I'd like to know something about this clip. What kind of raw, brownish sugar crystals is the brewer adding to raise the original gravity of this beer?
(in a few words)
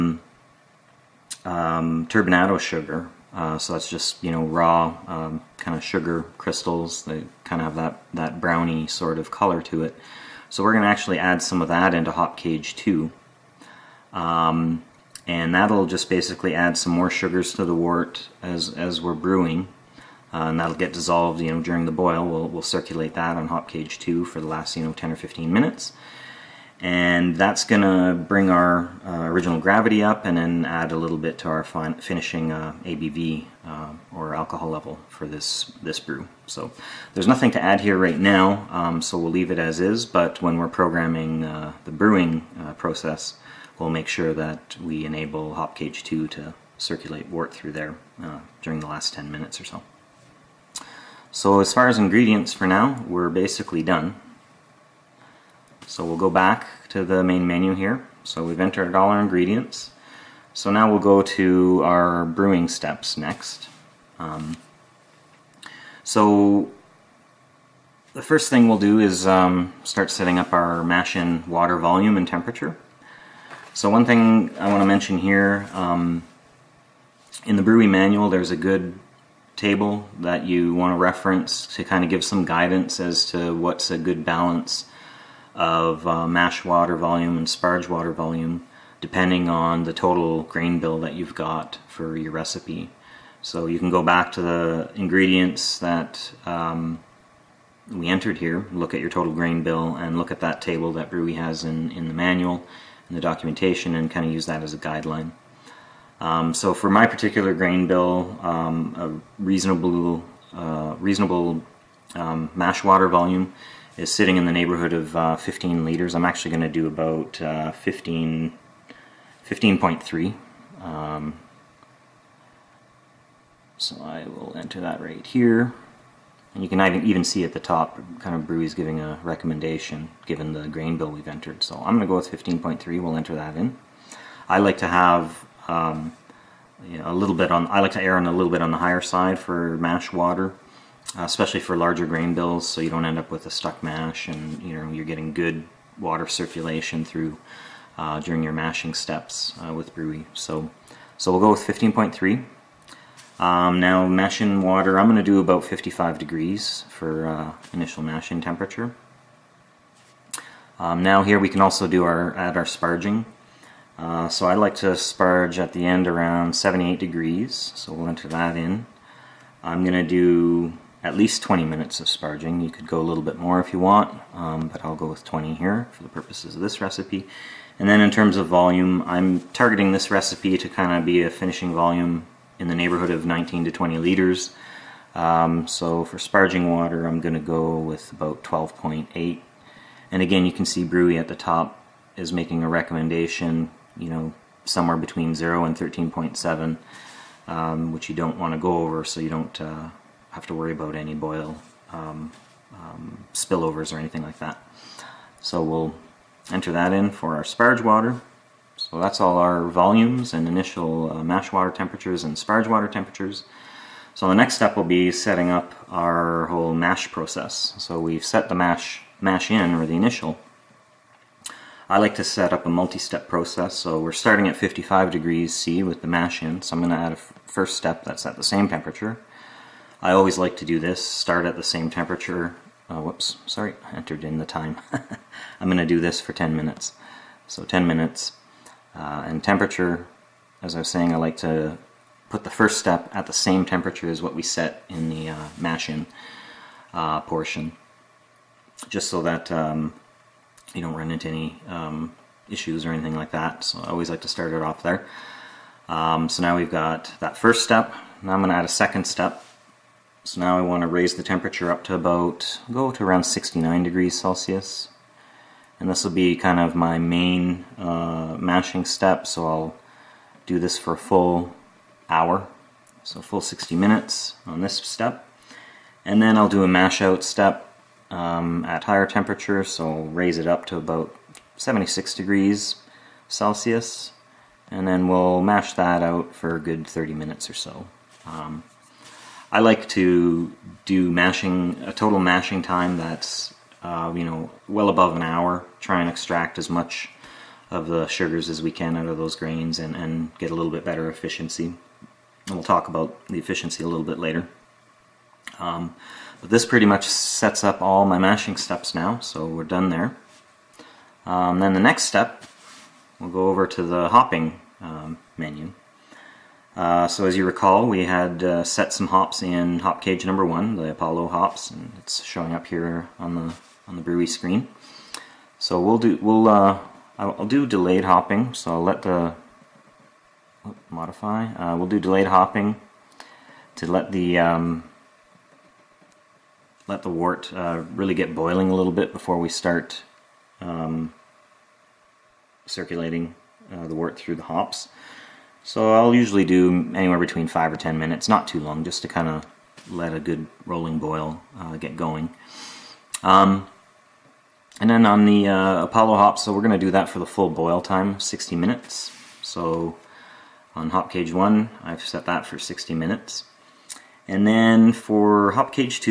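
turbinado sugar.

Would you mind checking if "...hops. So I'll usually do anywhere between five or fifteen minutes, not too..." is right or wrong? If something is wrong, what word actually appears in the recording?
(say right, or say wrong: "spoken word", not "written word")
wrong: "ten", not "fifteen".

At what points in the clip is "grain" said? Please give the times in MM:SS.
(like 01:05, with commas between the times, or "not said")
01:30, 01:39, 01:47, 02:10, 02:22, 04:59.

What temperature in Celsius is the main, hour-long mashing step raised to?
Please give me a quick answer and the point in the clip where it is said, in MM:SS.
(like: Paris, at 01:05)
69 degrees Celsius, at 04:23.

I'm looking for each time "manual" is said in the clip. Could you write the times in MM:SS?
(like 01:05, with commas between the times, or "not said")
01:17, 01:42.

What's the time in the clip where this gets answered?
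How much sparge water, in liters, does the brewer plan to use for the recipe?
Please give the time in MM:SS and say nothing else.
03:08.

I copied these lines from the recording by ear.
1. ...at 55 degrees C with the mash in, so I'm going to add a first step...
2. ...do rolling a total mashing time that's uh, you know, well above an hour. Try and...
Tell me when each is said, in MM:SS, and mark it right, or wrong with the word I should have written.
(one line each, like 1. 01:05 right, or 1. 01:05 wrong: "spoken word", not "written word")
1. 03:44 right
2. 04:50 wrong: "mashing", not "rolling".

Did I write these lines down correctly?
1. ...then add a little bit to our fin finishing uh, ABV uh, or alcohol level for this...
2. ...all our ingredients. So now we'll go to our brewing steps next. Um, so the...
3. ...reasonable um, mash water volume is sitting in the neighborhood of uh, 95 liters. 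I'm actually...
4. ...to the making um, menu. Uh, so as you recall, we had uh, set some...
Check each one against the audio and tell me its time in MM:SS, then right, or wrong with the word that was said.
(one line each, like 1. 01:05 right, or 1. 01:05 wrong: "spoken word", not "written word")
1. 00:30 right
2. 00:58 right
3. 01:50 wrong: "15", not "95"
4. 05:13 wrong: "hopping", not "making".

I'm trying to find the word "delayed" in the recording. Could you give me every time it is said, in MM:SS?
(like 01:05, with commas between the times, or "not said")
05:27, 05:31.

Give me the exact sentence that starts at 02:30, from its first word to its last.
So, so we'll go with 15.3.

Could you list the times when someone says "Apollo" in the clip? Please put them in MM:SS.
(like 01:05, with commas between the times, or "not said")
05:20, 05:55.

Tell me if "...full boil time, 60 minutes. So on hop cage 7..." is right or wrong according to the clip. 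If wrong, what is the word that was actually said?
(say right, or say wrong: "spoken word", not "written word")
wrong: "1", not "7".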